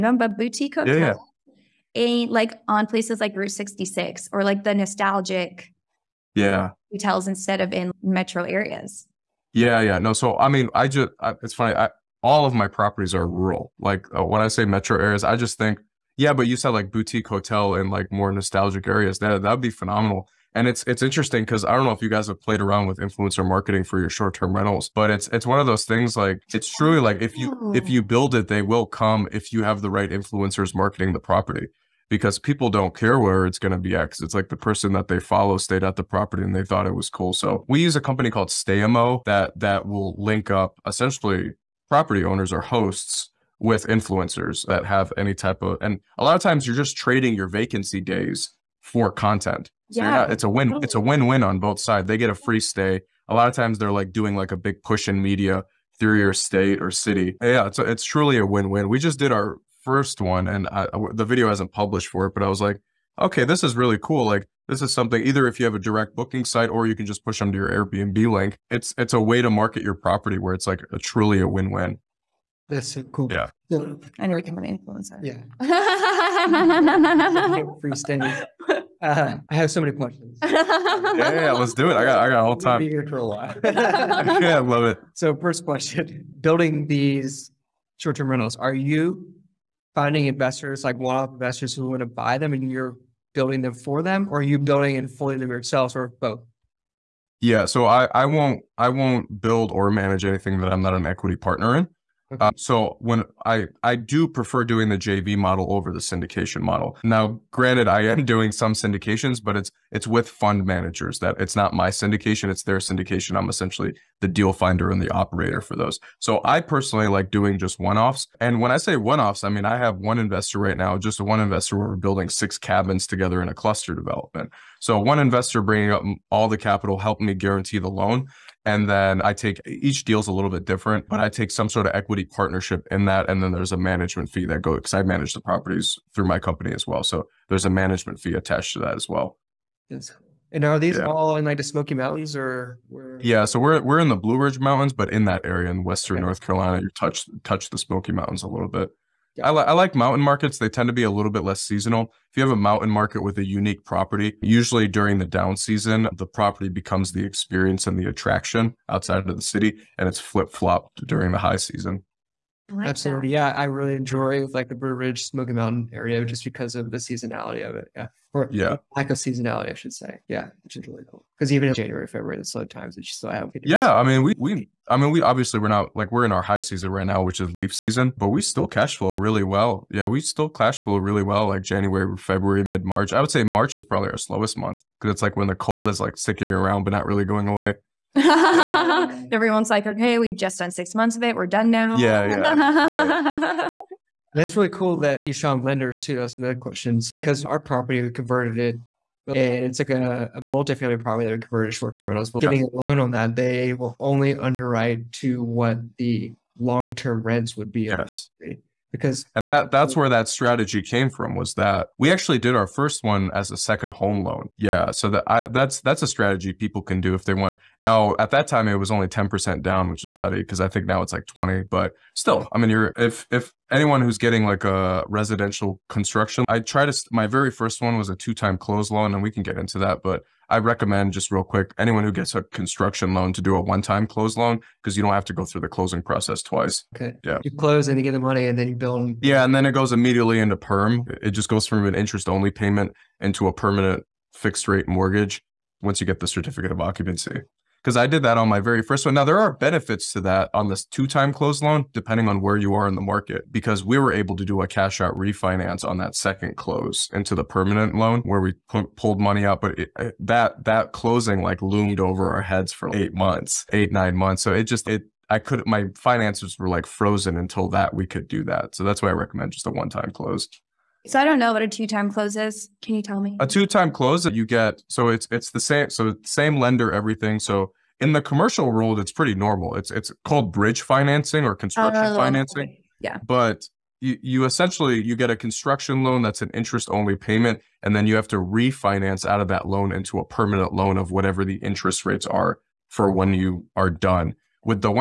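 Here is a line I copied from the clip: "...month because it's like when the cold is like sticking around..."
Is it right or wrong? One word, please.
right.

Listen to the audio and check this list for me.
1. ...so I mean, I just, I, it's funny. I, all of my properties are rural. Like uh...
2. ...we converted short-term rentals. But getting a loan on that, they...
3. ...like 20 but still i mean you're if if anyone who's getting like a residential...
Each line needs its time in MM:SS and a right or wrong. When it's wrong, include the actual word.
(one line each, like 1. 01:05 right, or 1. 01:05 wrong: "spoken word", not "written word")
1. 00:10 right
2. 03:21 right
3. 03:41 right.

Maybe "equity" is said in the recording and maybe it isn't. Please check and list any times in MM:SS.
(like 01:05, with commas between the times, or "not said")
01:41, 02:11.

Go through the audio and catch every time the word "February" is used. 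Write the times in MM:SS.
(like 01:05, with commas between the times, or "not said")
02:52, 03:02.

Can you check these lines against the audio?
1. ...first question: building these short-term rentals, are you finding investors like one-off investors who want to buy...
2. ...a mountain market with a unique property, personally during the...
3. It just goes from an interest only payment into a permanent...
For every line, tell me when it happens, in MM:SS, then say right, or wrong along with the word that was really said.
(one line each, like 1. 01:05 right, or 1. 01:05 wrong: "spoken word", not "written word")
1. 01:25 right
2. 02:32 wrong: "usually", not "personally"
3. 04:01 right.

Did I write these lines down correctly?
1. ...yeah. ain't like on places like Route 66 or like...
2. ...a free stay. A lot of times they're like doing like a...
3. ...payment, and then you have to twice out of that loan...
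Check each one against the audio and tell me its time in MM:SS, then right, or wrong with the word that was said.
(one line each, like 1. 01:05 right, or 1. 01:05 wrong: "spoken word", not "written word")
1. 00:01 right
2. 00:52 right
3. 04:47 wrong: "refinance", not "twice".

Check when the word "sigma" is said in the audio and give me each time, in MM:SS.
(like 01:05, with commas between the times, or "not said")
not said.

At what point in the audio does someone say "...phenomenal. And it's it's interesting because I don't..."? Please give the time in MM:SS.
00:19.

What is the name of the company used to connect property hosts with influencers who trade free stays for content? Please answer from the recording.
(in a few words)
Staymo.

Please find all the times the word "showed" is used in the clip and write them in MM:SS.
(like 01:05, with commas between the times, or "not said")
03:15.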